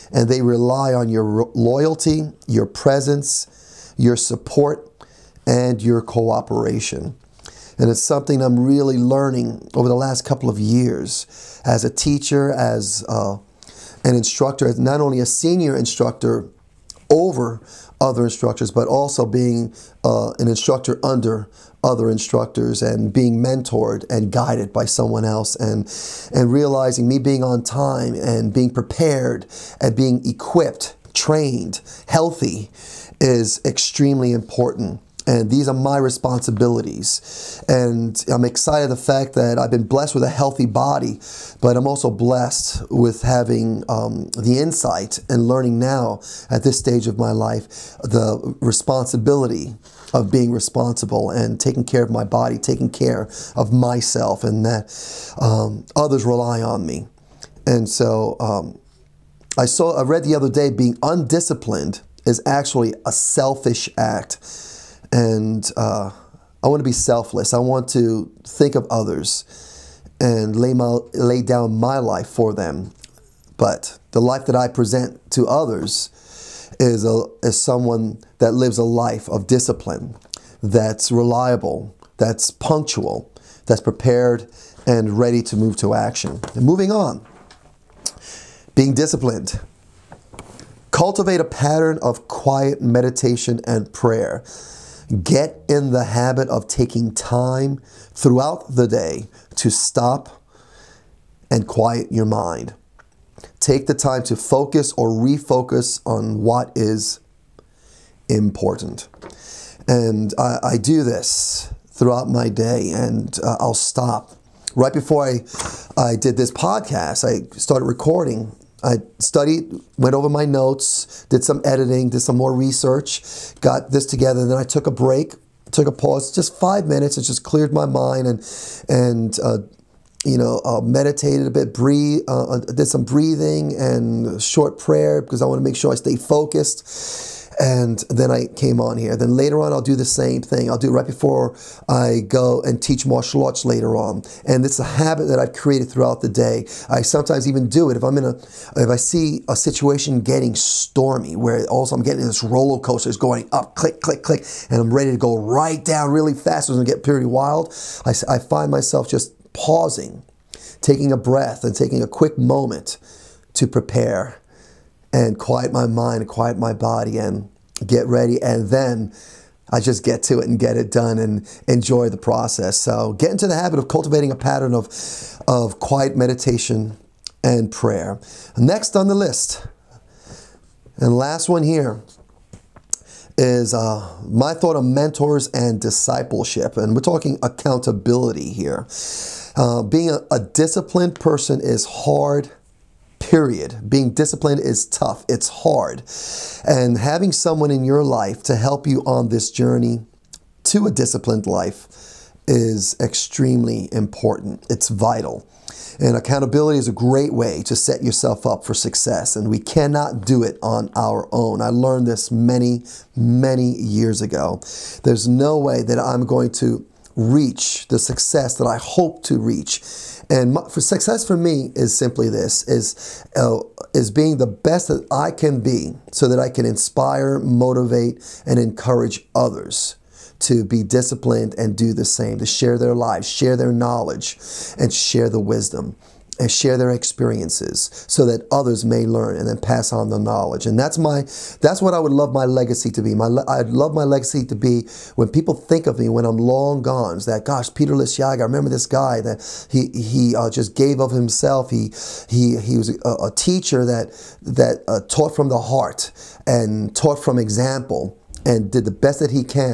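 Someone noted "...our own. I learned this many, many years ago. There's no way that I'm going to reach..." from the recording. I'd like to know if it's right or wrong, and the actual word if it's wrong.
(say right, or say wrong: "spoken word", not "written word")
right.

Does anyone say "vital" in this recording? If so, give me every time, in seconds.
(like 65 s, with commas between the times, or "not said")
204 s.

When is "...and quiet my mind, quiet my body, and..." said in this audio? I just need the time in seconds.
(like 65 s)
165 s.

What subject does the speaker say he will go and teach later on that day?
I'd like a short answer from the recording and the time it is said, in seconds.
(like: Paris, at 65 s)
Martial arts, at 143 s.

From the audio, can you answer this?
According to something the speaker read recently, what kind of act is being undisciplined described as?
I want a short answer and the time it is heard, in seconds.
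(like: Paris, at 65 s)
A selfish act, at 63 s.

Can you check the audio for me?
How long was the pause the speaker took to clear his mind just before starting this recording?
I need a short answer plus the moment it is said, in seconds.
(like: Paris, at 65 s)
5 minutes, at 126 s.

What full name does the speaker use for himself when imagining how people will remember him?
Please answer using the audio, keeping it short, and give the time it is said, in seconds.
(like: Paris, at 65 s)
Peter Liciaga, at 247 s.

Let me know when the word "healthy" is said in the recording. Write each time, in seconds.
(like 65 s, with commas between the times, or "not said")
32 s, 40 s.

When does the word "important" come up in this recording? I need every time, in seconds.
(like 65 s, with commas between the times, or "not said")
34 s, 108 s, 203 s.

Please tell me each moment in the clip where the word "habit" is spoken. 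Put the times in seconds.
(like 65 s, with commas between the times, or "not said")
96 s, 144 s, 173 s.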